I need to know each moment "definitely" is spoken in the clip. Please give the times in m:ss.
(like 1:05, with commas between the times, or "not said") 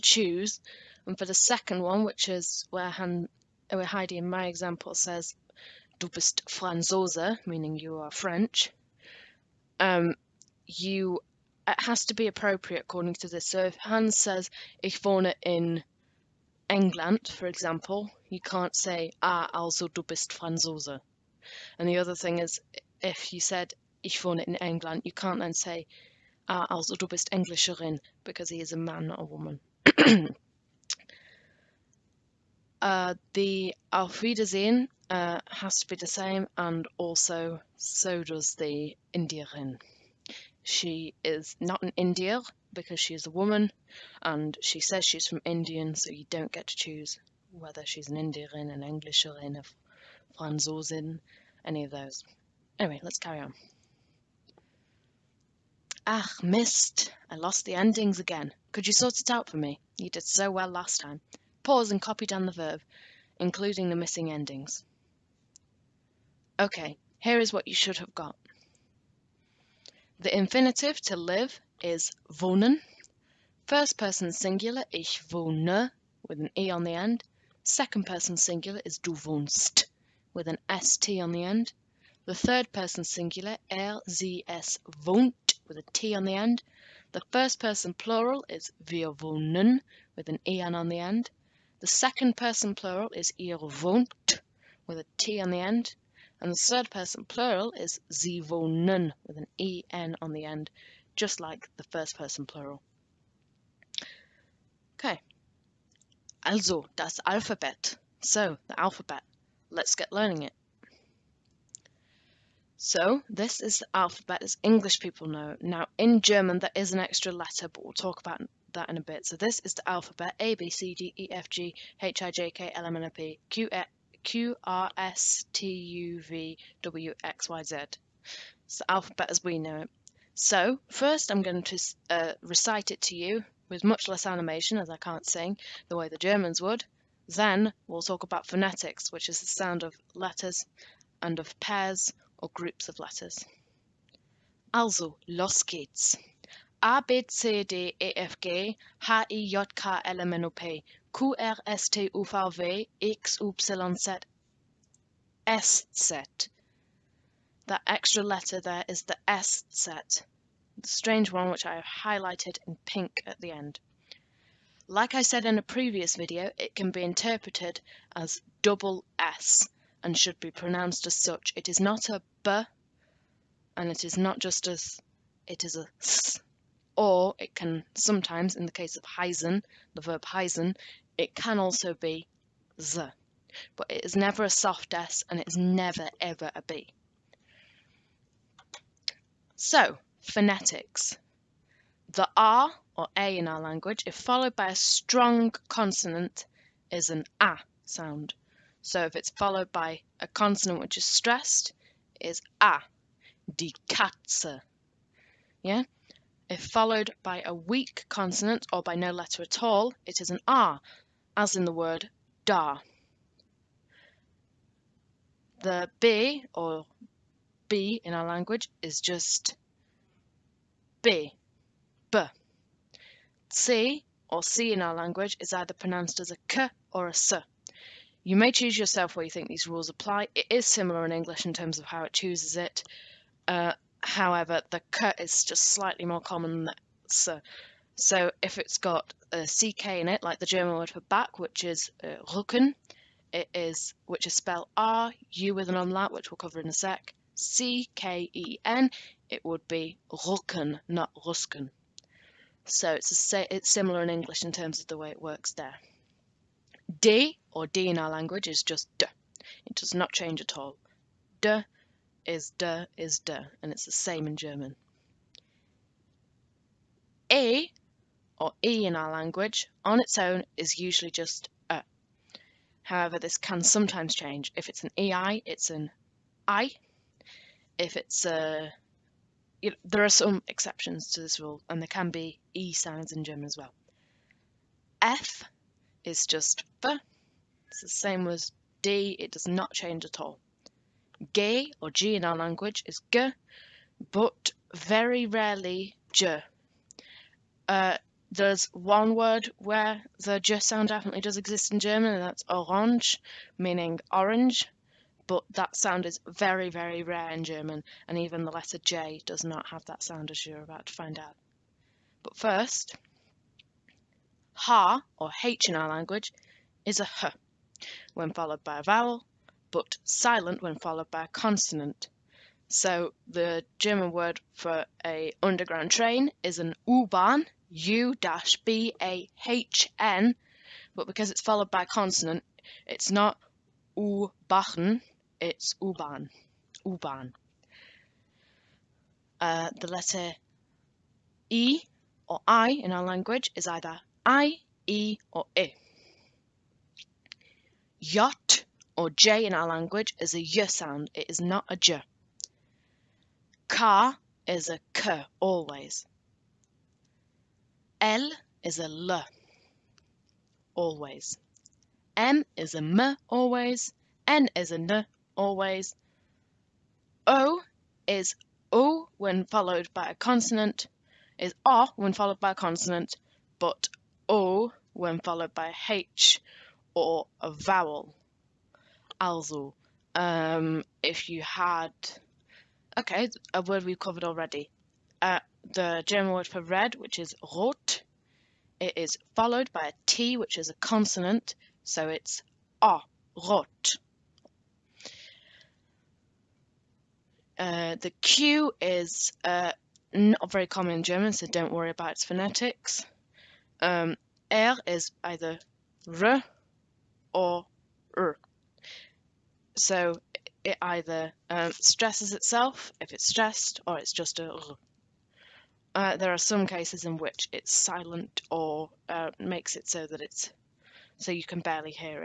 5:00.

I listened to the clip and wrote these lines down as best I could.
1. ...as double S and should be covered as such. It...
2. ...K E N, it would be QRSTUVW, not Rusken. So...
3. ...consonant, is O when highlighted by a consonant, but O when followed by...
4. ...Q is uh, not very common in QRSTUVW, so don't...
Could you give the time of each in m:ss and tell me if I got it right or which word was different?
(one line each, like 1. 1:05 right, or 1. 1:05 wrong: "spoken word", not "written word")
1. 2:48 wrong: "pronounced", not "covered"
2. 4:07 wrong: "Rücken", not "QRSTUVW"
3. 6:10 wrong: "followed", not "highlighted"
4. 6:38 wrong: "German", not "QRSTUVW".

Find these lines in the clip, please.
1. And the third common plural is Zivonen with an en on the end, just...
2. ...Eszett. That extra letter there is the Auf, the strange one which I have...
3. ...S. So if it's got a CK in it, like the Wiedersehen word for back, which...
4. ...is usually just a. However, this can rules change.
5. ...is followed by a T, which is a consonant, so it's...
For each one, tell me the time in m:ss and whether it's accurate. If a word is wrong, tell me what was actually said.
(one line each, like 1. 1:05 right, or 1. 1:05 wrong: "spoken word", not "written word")
1. 1:36 wrong: "person", not "common"
2. 2:35 wrong: "Eszett", not "Auf"
3. 3:57 wrong: "German", not "Wiedersehen"
4. 4:30 wrong: "sometimes", not "rules"
5. 6:28 right.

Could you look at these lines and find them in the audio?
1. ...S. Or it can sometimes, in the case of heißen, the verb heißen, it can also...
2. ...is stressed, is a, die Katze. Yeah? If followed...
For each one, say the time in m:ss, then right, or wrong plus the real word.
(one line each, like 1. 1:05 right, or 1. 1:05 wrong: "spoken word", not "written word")
1. 2:55 right
2. 3:20 right.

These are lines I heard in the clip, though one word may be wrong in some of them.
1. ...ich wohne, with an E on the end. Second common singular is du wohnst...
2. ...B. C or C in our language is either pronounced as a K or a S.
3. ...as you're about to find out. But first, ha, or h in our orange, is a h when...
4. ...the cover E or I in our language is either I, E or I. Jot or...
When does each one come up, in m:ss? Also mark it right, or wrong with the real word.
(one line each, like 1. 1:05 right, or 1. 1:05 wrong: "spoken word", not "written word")
1. 1:14 wrong: "person", not "common"
2. 3:42 right
3. 5:10 wrong: "language", not "orange"
4. 5:39 wrong: "letter", not "cover".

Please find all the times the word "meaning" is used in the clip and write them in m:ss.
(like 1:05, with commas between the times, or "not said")
0:07, 5:03.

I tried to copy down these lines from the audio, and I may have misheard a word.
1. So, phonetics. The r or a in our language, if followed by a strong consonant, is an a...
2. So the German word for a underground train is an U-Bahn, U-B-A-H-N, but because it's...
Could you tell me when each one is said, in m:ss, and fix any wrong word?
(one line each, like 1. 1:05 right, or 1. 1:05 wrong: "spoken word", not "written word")
1. 3:09 right
2. 5:22 right.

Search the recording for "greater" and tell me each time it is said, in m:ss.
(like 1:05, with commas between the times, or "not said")
not said.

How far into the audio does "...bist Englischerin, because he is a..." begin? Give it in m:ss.
0:27.